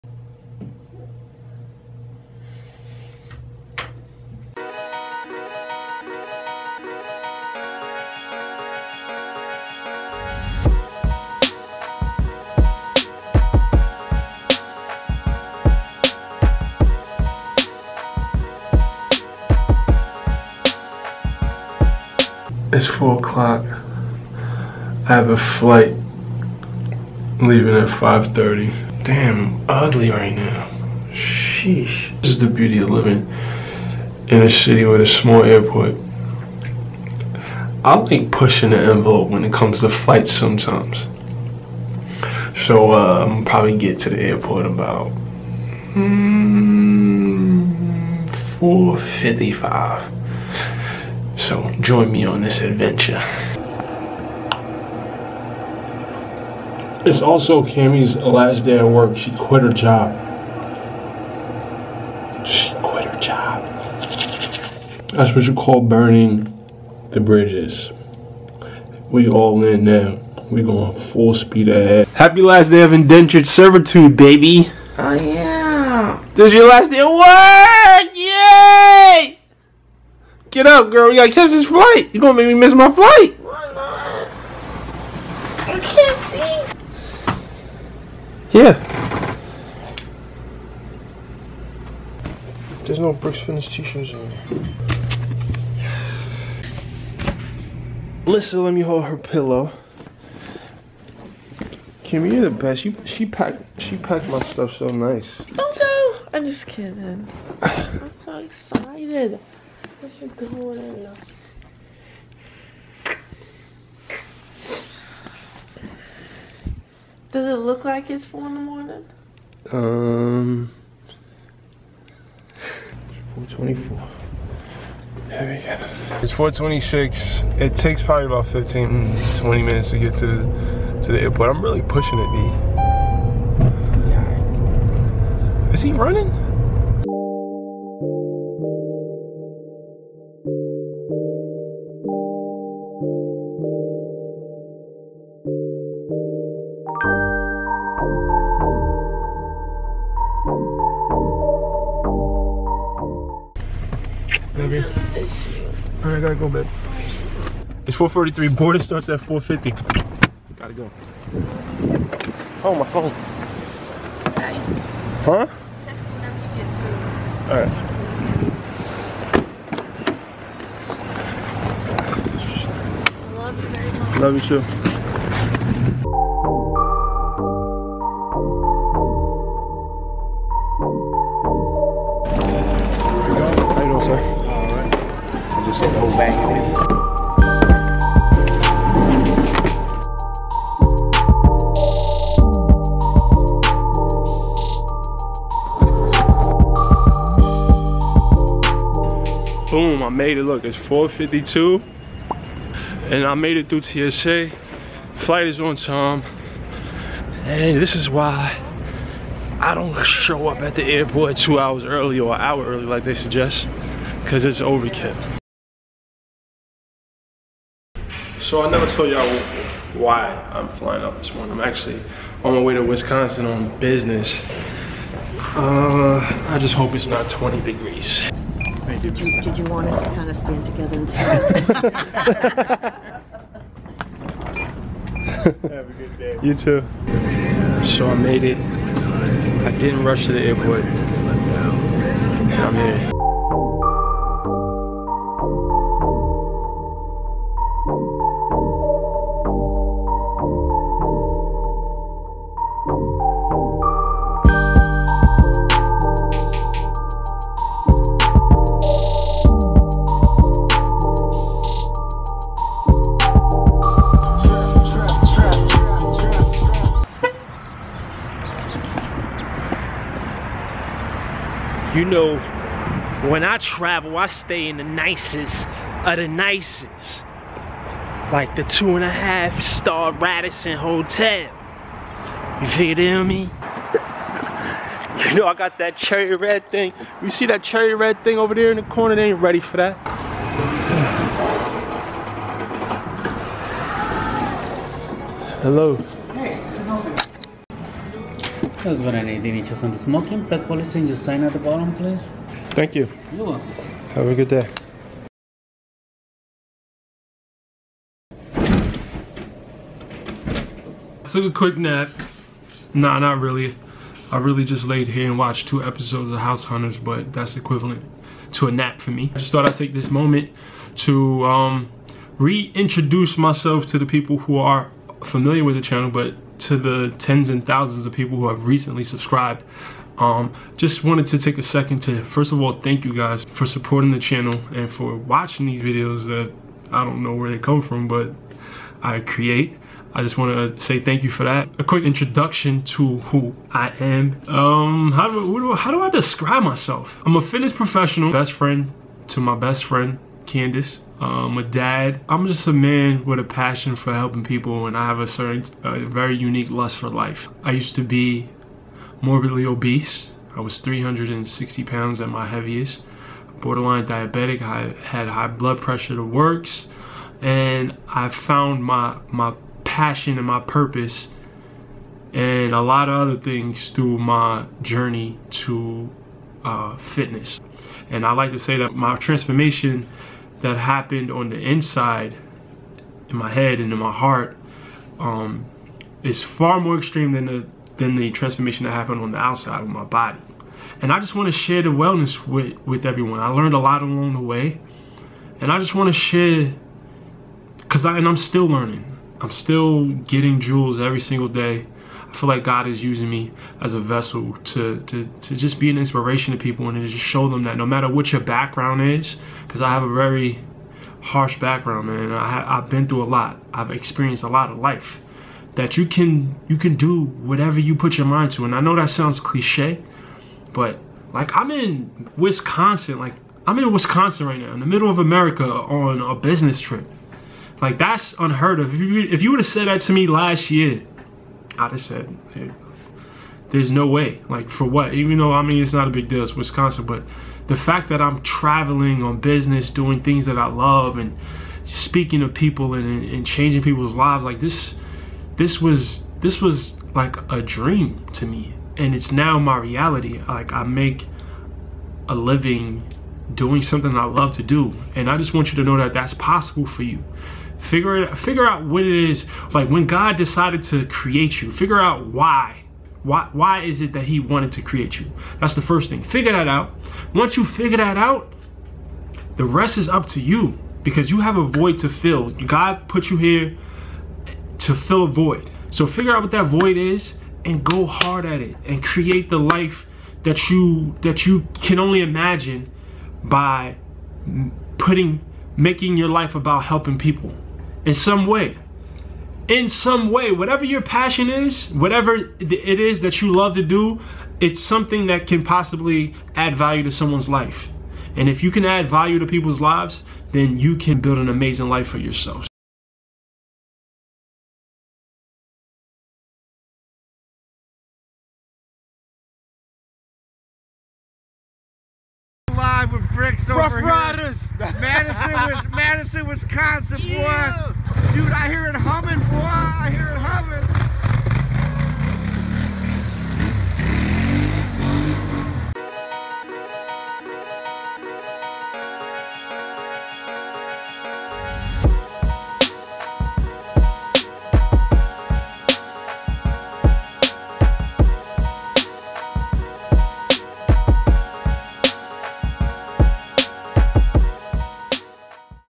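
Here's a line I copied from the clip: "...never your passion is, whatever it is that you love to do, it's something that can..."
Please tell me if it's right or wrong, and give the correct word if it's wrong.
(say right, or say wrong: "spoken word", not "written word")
wrong: "whatever", not "never".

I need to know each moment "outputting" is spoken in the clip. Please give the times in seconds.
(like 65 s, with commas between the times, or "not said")
not said.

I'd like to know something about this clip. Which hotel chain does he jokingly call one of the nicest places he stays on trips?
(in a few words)
Radisson.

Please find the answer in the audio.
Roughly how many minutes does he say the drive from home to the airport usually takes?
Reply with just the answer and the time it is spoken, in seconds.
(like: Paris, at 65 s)
15 to 20 minutes, at 128 s.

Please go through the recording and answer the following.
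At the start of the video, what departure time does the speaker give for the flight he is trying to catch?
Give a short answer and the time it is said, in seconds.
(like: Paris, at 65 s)
5:30, at 27 s.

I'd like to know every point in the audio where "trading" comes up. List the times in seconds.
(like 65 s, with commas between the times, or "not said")
not said.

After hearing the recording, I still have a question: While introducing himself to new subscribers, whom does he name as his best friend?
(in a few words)
Candace.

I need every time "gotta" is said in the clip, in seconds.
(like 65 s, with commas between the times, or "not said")
81 s, 156 s, 160 s.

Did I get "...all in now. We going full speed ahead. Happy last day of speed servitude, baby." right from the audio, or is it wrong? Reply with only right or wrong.
wrong.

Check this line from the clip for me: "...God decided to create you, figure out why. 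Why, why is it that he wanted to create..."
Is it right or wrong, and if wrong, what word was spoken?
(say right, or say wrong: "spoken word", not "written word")
right.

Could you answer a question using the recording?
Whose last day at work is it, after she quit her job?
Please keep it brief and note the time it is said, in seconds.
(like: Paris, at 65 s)
Cami, at 57 s.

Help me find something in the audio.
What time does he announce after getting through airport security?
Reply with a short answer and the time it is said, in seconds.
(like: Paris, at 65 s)
4:52, at 200 s.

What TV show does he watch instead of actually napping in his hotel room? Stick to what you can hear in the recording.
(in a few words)
House Hunters.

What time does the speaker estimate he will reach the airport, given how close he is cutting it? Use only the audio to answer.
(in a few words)
4:55.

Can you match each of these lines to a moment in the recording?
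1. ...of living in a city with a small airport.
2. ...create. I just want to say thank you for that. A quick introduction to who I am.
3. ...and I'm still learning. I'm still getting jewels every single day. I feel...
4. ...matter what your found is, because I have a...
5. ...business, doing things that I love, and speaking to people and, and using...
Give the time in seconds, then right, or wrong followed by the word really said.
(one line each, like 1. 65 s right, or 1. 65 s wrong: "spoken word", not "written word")
1. 32 s right
2. 339 s right
3. 398 s right
4. 407 s wrong: "background", not "found"
5. 439 s wrong: "changing", not "using".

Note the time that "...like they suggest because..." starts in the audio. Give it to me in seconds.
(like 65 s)
212 s.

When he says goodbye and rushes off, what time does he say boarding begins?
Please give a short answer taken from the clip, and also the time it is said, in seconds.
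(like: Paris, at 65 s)
4:50, at 159 s.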